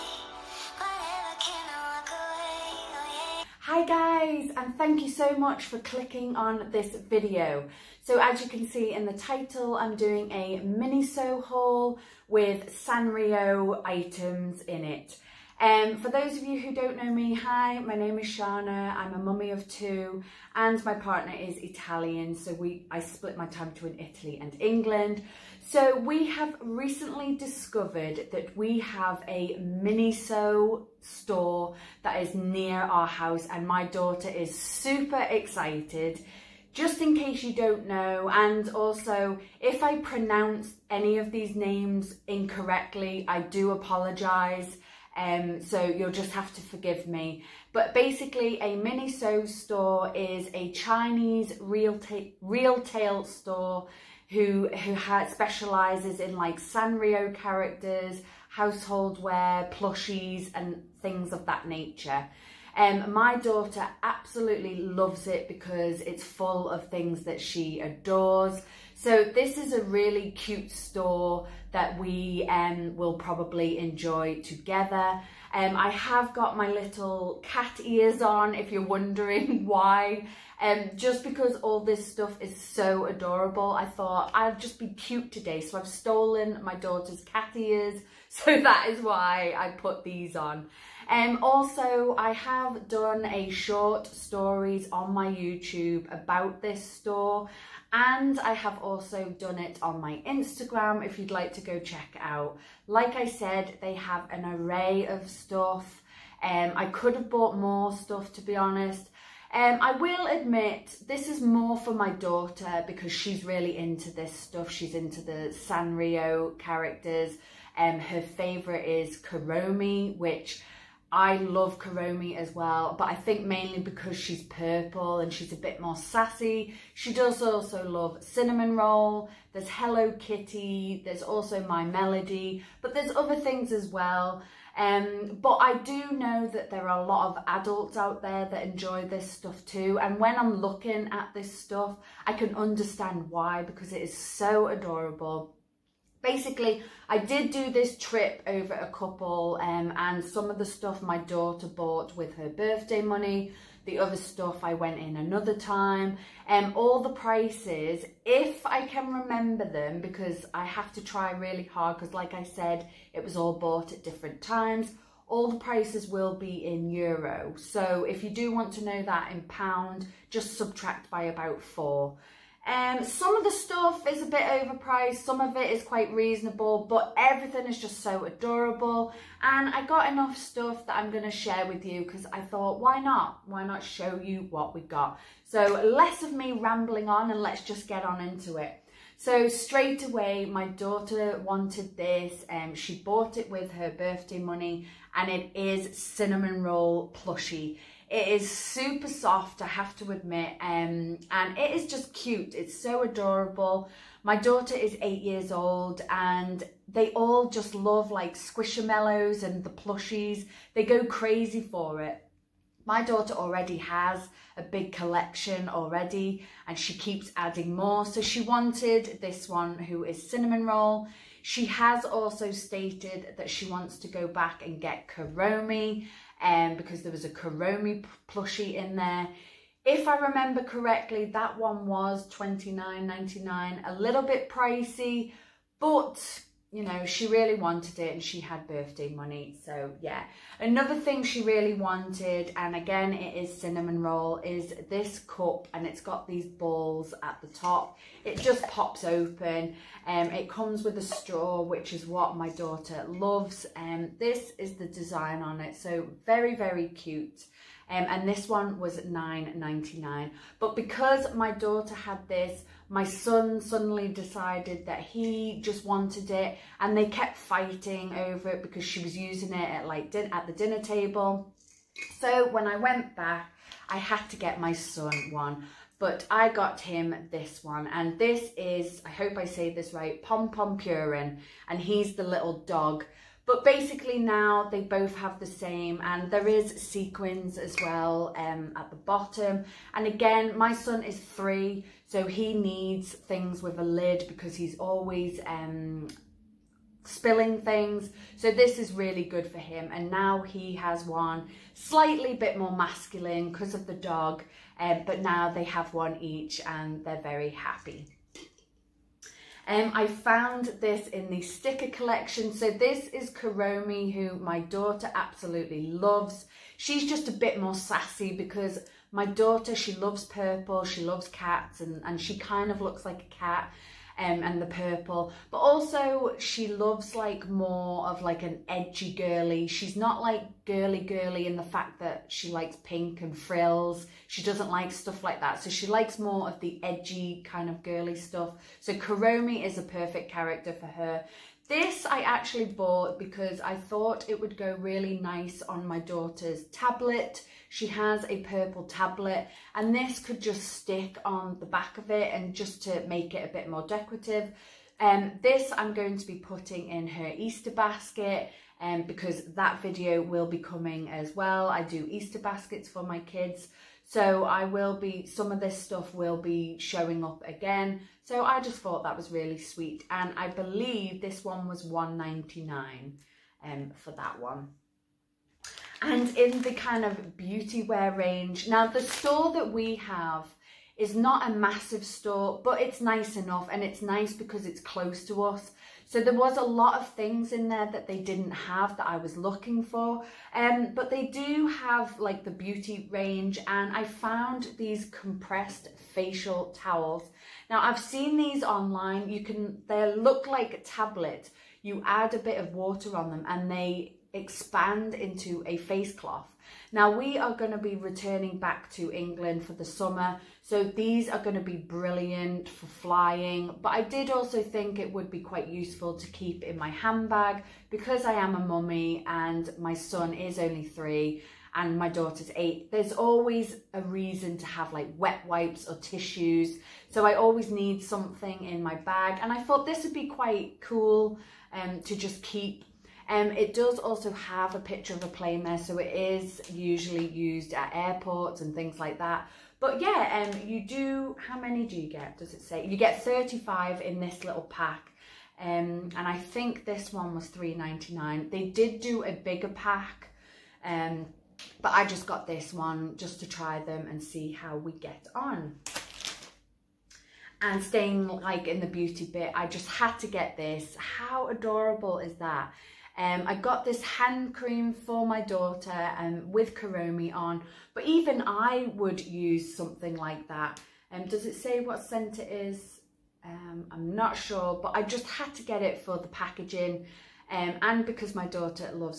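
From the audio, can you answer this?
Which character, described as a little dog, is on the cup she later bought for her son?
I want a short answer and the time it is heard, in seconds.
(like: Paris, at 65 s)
Pompompurin, at 280 s.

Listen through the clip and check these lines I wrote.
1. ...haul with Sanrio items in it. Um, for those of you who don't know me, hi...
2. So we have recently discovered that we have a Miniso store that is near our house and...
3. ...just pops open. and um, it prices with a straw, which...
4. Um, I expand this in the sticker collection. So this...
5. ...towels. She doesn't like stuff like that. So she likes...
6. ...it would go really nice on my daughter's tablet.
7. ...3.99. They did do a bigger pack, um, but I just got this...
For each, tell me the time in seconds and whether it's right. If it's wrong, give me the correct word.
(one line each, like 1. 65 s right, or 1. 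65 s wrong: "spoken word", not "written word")
1. 11 s right
2. 25 s right
3. 248 s wrong: "comes", not "prices"
4. 309 s wrong: "found", not "expand"
5. 333 s wrong: "frills", not "towels"
6. 344 s right
7. 447 s right.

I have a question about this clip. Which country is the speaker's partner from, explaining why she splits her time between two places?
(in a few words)
Italy.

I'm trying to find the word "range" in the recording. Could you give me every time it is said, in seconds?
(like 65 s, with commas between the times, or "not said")
378 s, 393 s.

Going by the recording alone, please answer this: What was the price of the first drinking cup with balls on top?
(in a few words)
9.99.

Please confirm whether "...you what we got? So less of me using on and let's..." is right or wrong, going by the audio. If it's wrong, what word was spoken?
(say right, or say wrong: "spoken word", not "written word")
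wrong: "rambling", not "using".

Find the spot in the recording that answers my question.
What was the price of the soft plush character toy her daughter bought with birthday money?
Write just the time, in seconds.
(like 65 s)
232 s.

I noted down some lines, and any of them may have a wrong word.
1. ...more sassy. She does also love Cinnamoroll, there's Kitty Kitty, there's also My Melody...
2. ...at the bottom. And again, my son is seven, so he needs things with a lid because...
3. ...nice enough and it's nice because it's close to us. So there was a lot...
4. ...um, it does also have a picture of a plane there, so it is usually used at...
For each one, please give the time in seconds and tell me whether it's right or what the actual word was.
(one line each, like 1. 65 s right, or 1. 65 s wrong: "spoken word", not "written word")
1. 125 s wrong: "Hello", not "Kitty"
2. 288 s wrong: "three", not "seven"
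3. 382 s right
4. 433 s right.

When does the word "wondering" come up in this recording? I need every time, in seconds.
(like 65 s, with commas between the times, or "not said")
78 s.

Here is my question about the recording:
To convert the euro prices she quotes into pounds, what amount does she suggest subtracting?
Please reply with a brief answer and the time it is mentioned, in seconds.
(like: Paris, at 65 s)
4, at 171 s.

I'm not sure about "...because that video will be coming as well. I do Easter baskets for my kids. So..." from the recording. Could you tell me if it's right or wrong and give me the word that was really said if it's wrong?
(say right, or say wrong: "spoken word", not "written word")
right.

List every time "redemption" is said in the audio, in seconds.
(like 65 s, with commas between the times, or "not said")
not said.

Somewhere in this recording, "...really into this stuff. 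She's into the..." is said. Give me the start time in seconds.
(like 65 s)
113 s.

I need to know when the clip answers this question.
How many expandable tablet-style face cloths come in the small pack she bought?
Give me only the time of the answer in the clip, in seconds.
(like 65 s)
443 s.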